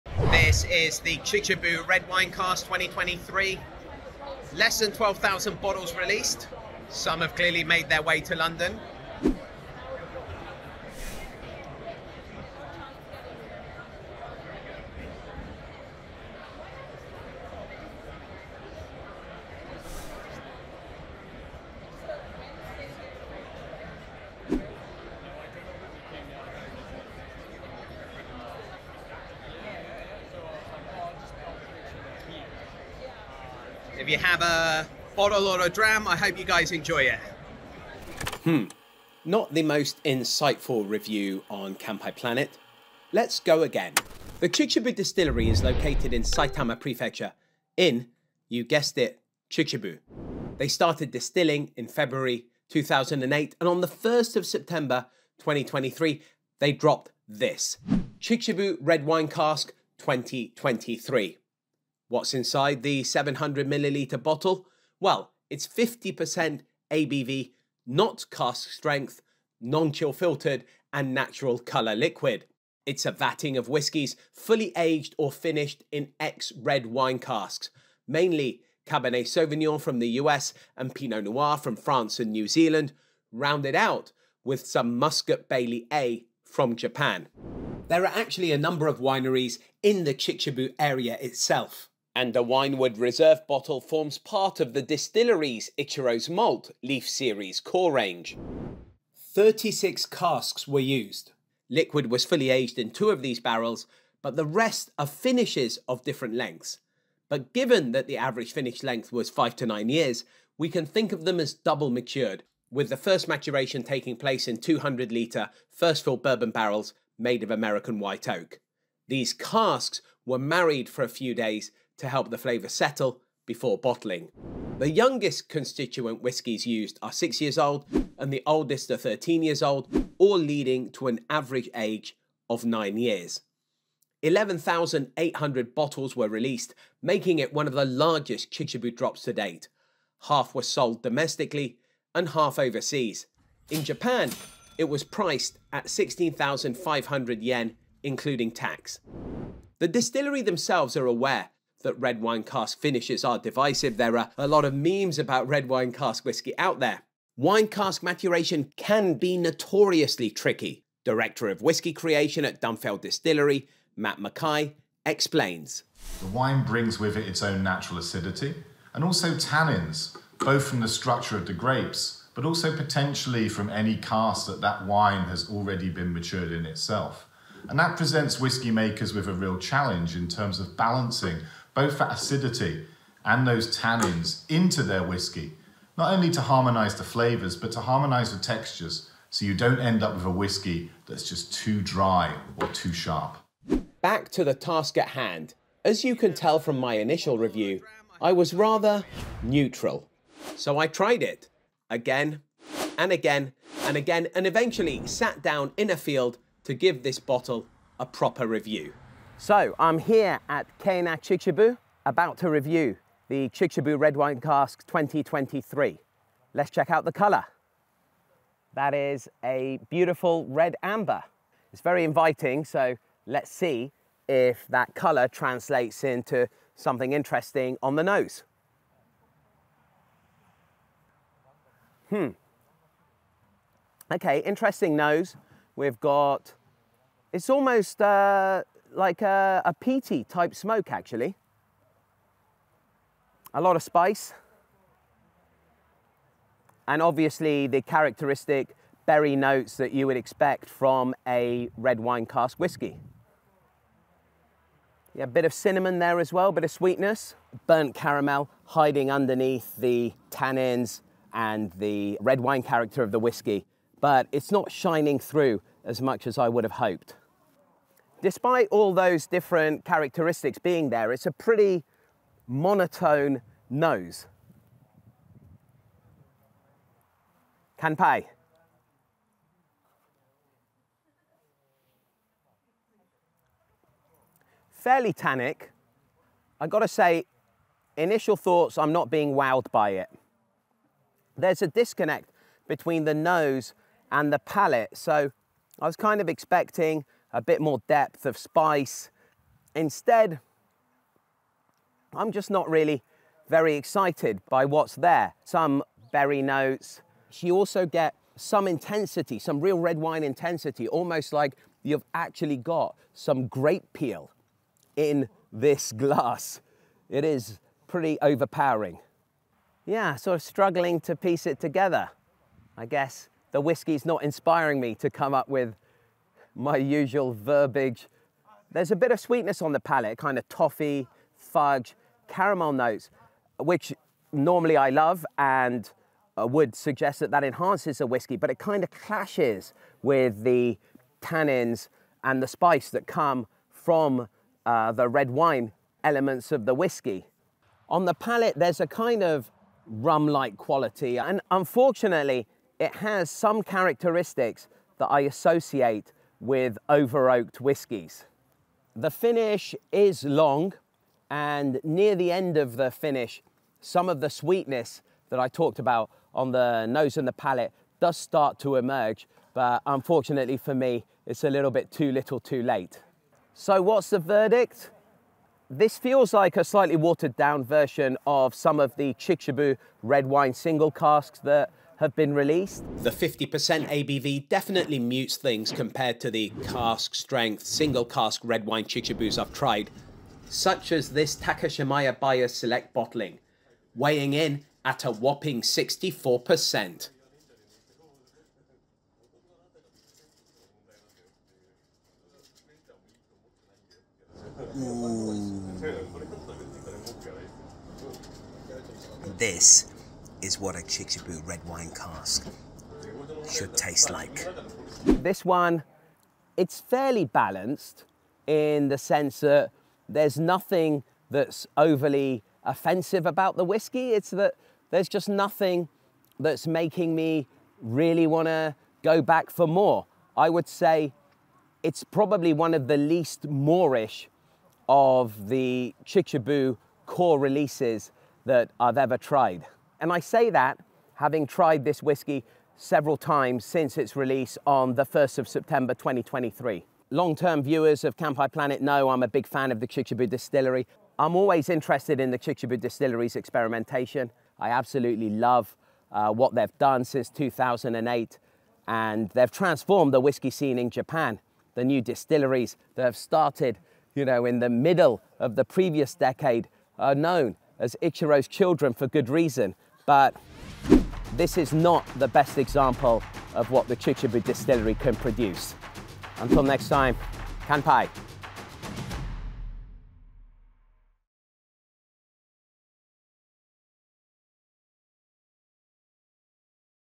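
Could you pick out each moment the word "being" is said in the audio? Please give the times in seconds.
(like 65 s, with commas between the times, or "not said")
270 s, 289 s.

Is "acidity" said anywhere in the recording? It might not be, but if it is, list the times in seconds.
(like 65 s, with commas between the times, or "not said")
167 s, 182 s.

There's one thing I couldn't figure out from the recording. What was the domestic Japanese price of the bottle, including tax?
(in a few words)
16,500 yen.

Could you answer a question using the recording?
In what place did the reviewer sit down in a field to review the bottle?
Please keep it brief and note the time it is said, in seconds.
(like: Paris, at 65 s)
Kena Chichibu, at 210 s.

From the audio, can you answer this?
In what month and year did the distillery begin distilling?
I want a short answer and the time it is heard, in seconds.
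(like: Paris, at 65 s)
February 2008, at 51 s.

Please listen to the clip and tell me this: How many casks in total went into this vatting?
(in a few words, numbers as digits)
36.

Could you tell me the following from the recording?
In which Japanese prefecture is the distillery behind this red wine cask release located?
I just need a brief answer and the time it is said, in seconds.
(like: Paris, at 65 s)
Saitama, at 46 s.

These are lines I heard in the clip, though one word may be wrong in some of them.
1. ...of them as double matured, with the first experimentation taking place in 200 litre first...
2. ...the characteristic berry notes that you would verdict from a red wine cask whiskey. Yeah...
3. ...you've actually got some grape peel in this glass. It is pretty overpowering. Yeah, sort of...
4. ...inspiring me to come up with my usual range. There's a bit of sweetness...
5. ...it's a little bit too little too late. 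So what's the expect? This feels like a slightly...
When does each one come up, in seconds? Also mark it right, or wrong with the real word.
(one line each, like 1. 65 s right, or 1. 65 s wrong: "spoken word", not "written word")
1. 111 s wrong: "maturation", not "experimentation"
2. 247 s wrong: "expect", not "verdict"
3. 311 s right
4. 324 s wrong: "verbiage", not "range"
5. 371 s wrong: "verdict", not "expect".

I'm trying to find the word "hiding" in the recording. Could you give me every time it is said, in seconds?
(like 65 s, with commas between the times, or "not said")
258 s.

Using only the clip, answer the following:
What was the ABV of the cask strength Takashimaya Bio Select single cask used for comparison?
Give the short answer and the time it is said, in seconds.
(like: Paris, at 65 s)
64%, at 395 s.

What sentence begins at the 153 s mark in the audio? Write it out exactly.
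There are a lot of memes about red wine cask whiskey out there.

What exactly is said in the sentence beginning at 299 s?
Instead, I'm just not really very excited by what's there.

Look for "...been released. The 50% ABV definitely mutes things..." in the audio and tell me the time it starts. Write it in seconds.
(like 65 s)
382 s.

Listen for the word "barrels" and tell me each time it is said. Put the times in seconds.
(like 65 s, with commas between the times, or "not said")
103 s, 116 s.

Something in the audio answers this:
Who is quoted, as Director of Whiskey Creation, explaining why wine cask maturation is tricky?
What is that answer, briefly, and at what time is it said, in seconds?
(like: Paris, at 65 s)
Matt Mackay, at 163 s.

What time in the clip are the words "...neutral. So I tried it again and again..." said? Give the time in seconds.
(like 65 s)
199 s.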